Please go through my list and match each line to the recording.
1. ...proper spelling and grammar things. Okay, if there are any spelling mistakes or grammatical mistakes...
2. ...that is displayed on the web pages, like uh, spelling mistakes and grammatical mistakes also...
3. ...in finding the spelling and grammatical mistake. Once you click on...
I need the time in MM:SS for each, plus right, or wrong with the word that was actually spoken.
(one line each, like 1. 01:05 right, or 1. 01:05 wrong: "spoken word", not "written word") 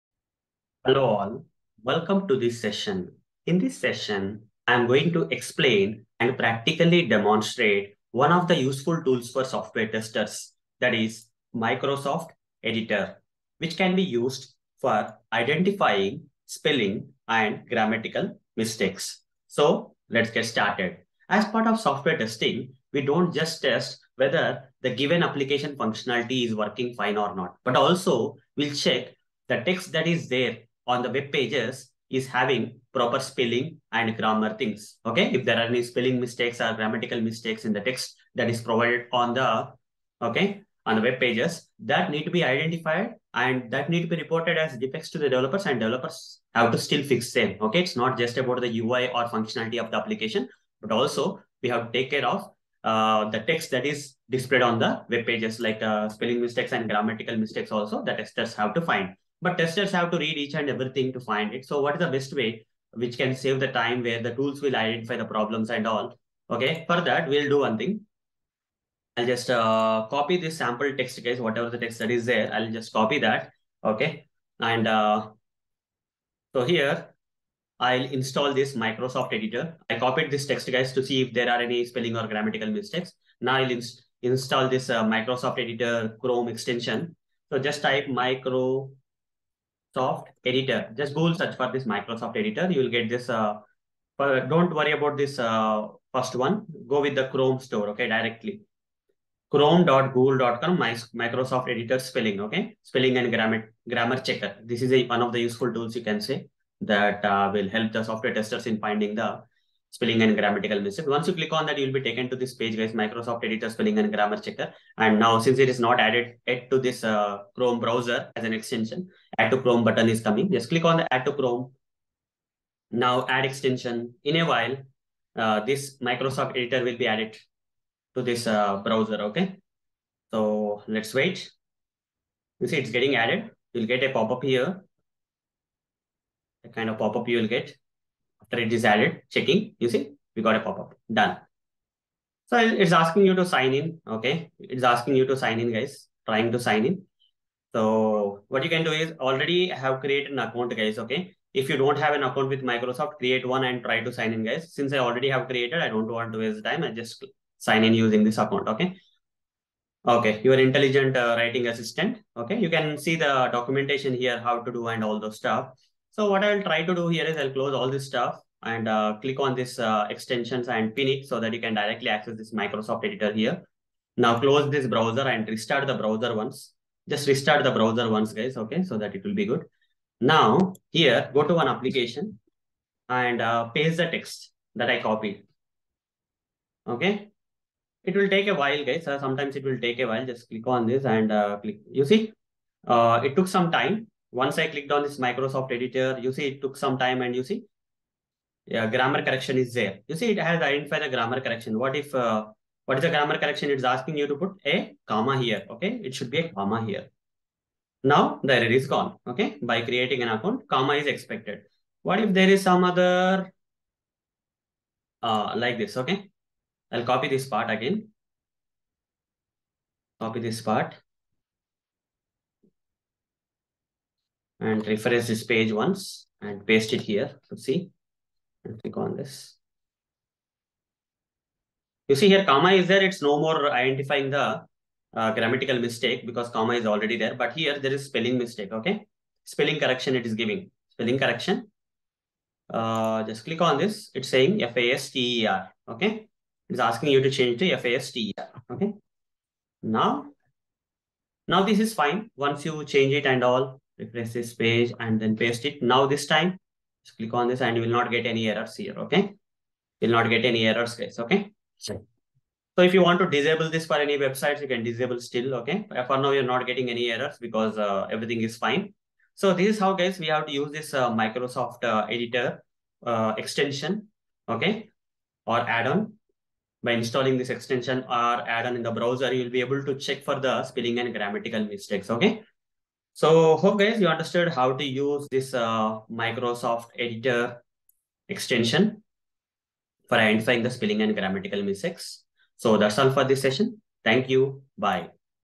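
1. 00:32 right
2. 00:53 right
3. 01:48 right.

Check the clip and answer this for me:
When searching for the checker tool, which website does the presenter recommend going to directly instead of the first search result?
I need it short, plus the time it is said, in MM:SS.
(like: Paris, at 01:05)
Chrome store, at 01:37.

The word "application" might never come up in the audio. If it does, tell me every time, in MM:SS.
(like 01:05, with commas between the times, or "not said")
00:25, 00:49, 03:01.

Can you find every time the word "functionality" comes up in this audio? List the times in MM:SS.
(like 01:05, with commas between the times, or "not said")
00:25, 00:49.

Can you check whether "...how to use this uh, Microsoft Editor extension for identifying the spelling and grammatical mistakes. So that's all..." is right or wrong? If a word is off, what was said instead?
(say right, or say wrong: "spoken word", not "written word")
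right.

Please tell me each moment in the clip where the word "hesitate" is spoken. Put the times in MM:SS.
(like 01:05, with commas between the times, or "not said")
not said.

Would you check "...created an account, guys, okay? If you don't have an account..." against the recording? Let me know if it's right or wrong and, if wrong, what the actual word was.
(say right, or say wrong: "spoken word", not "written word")
right.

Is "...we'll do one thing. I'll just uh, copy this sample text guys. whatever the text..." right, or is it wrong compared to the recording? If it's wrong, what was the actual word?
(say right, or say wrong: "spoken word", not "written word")
right.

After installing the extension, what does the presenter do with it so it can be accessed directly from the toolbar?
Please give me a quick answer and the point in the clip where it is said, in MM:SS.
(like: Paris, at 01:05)
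Pin it, at 02:50.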